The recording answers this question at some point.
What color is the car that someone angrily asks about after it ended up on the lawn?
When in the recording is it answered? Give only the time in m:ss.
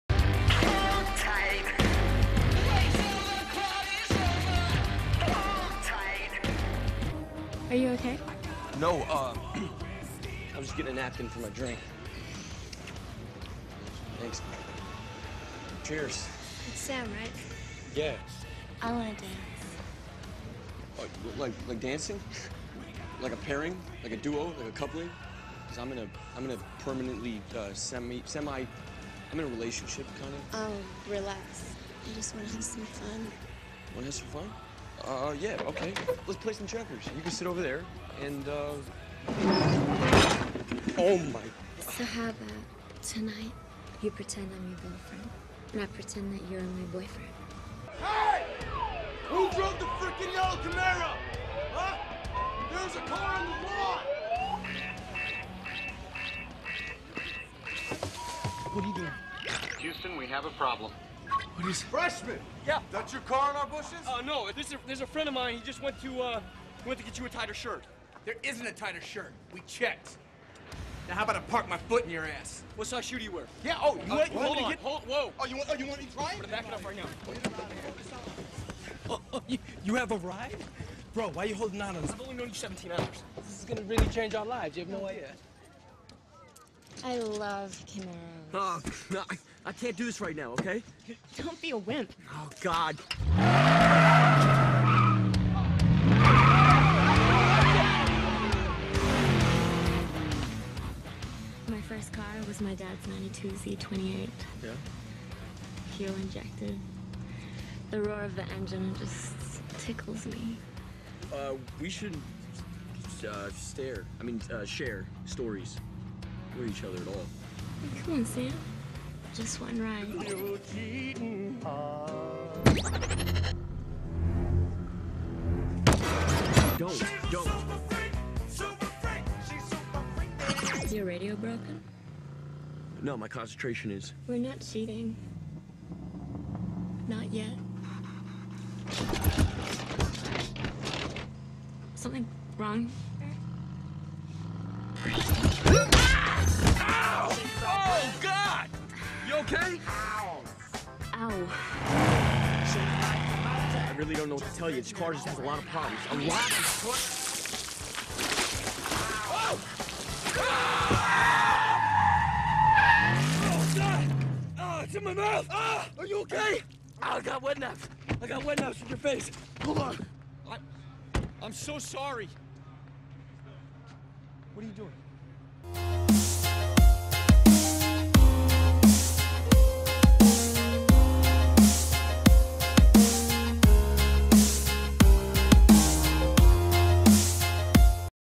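0:50.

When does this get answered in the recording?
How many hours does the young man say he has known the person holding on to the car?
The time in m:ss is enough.
1:22.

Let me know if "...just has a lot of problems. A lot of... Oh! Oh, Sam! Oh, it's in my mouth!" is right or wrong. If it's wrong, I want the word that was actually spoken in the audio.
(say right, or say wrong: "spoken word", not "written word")
wrong: "God", not "Sam".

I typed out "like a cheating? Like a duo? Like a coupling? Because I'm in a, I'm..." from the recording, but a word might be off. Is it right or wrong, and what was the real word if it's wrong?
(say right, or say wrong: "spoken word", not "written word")
wrong: "pairing", not "cheating".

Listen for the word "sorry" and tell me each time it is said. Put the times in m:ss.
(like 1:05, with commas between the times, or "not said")
2:51.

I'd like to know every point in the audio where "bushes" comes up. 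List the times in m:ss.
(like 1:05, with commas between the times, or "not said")
1:03.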